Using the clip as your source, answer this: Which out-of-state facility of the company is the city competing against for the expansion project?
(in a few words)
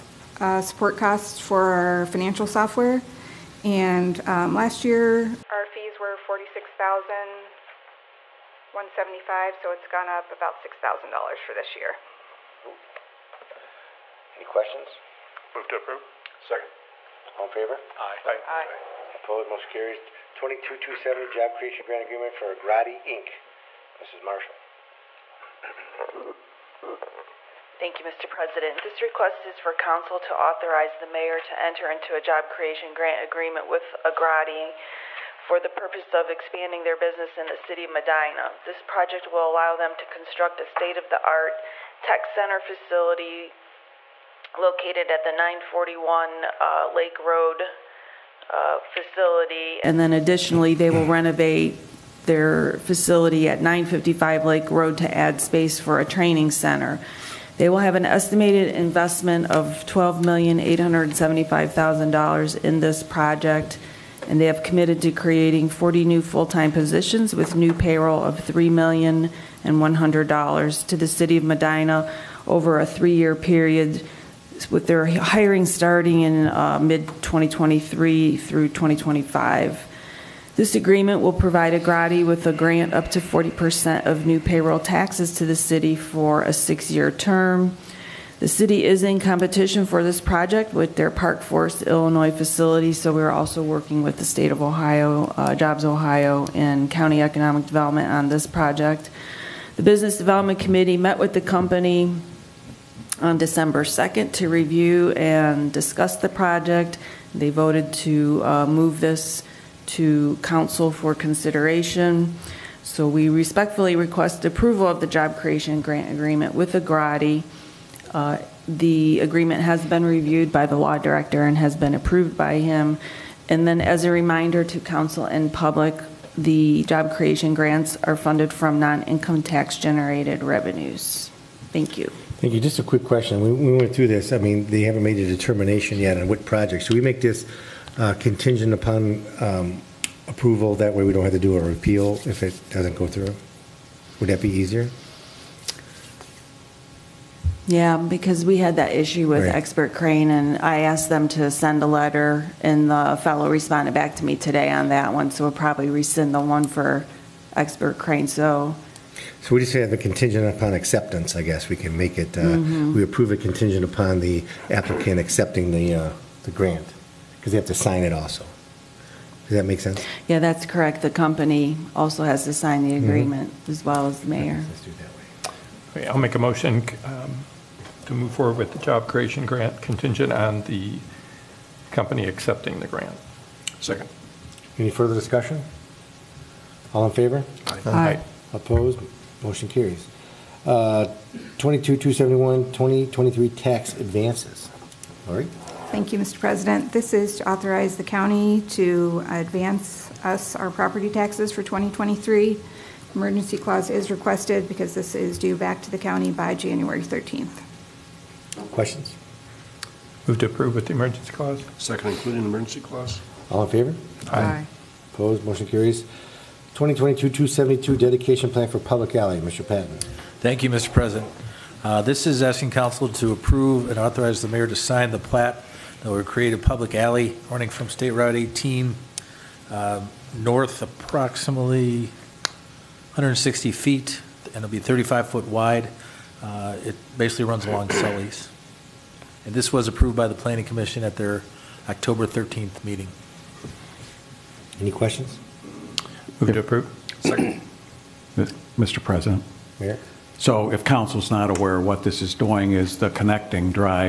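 Park Forest, Illinois.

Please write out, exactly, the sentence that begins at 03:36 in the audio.
2022-272 dedication plan for public alley.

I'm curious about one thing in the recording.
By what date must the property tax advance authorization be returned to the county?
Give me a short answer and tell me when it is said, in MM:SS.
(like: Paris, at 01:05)
January 13th, at 03:26.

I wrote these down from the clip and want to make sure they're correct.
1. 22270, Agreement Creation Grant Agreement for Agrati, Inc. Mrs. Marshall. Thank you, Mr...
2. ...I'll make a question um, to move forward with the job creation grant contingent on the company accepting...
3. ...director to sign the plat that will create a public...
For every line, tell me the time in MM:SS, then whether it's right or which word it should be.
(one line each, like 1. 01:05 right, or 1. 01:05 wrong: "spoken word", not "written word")
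1. 00:20 wrong: "Job", not "Agreement"
2. 02:56 wrong: "motion", not "question"
3. 03:44 wrong: "mayor", not "director".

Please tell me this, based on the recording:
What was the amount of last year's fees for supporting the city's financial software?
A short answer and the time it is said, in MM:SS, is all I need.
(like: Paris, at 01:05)
$46,175, at 00:06.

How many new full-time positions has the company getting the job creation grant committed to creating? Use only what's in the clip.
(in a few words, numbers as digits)
40.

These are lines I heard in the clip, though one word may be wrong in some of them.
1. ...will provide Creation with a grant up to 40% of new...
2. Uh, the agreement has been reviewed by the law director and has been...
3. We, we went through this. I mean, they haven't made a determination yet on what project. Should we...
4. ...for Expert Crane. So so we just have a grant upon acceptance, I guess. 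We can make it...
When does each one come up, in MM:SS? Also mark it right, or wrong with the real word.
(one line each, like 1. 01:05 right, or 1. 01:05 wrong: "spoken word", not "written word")
1. 01:21 wrong: "Agrati", not "Creation"
2. 01:58 right
3. 02:13 right
4. 02:36 wrong: "contingent", not "grant".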